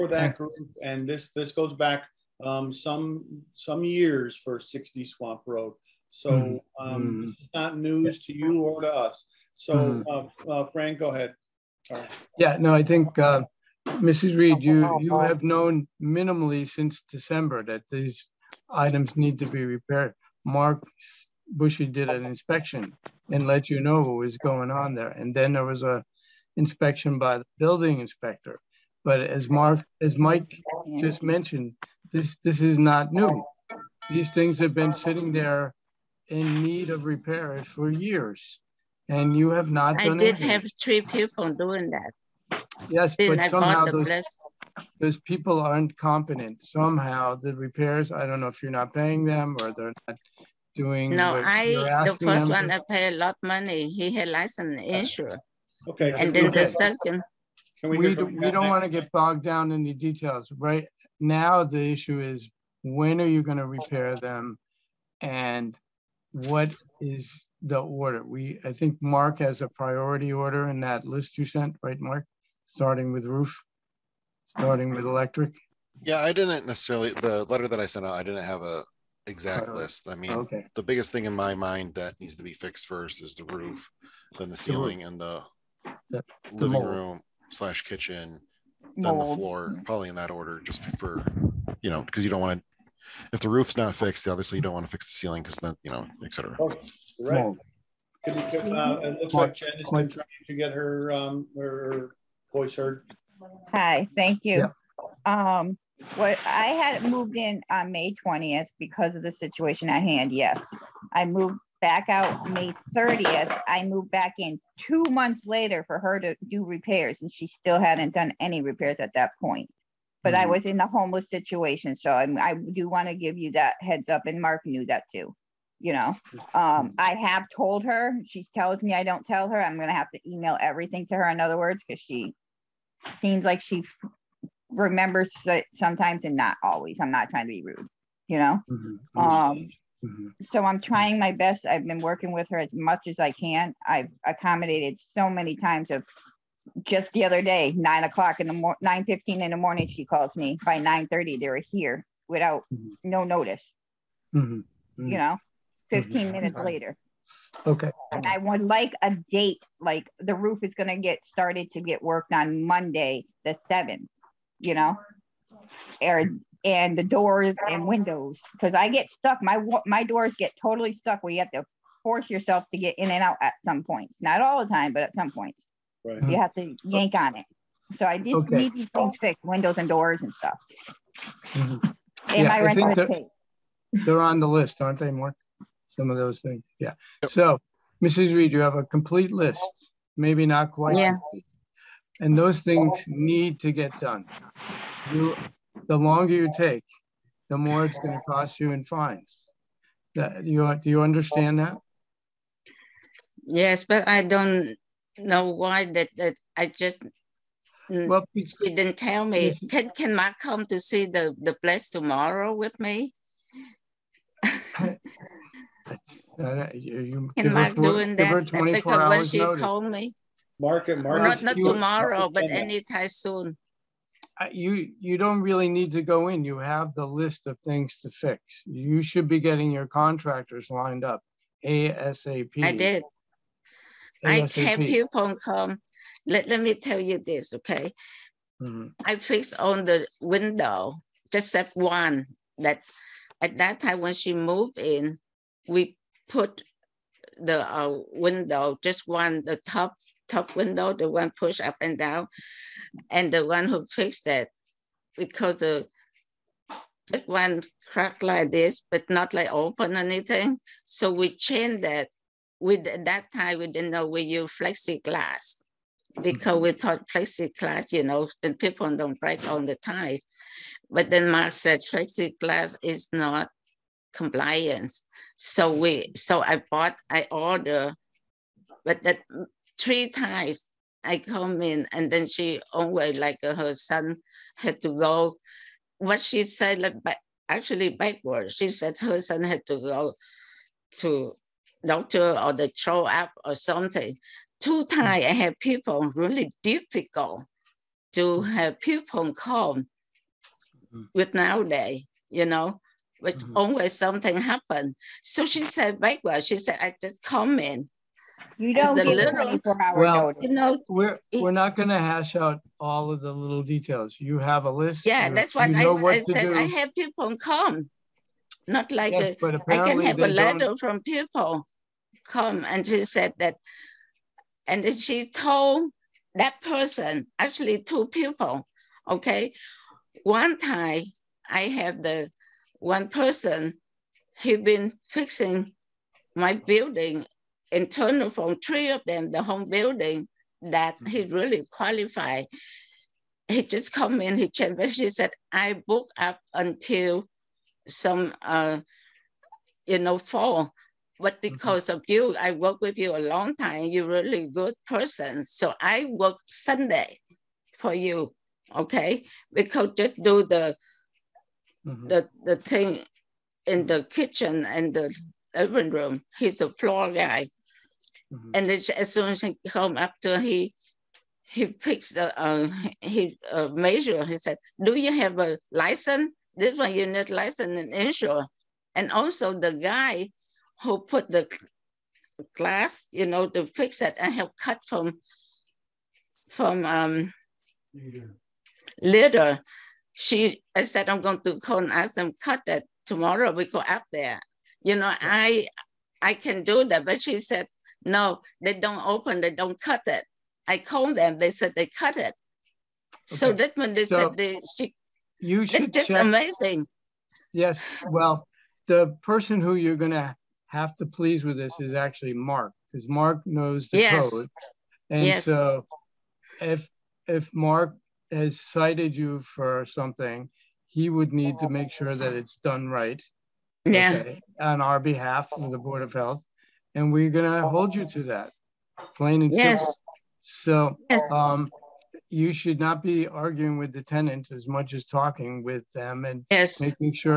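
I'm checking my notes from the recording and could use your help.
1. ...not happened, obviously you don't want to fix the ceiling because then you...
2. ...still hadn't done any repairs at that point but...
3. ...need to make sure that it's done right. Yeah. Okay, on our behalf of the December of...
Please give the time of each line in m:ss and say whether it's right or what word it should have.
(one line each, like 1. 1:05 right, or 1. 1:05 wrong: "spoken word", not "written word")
1. 1:33 wrong: "fixed", not "happened"
2. 1:57 right
3. 7:01 wrong: "Board", not "December".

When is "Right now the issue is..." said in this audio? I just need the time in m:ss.
1:00.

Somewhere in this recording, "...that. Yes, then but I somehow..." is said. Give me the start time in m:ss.
0:41.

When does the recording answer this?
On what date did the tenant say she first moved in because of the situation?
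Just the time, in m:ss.
1:47.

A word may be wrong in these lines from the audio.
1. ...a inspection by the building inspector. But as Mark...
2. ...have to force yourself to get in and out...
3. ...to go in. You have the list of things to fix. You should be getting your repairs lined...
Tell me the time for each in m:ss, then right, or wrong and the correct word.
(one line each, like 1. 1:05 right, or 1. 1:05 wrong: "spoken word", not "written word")
1. 0:25 right
2. 2:51 right
3. 3:45 wrong: "contractors", not "repairs".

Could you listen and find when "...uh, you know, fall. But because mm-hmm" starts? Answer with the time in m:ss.
5:48.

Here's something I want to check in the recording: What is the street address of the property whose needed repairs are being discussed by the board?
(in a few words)
60 Swamp Road.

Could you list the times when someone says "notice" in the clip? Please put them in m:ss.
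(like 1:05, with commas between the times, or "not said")
2:33, 3:39.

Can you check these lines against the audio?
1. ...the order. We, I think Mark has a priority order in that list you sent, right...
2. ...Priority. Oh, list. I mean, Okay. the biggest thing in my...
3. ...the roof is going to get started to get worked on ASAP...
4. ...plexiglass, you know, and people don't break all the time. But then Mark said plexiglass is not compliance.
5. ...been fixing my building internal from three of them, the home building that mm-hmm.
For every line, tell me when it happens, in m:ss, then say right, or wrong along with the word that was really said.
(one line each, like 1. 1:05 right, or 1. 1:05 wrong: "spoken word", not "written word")
1. 1:07 right
2. 1:19 right
3. 2:40 wrong: "Monday", not "ASAP"
4. 4:27 right
5. 5:34 right.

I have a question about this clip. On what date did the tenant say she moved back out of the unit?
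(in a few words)
May 30th.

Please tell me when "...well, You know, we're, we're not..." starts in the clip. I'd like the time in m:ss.
5:09.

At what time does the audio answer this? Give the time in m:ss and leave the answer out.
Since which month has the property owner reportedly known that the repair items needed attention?
0:17.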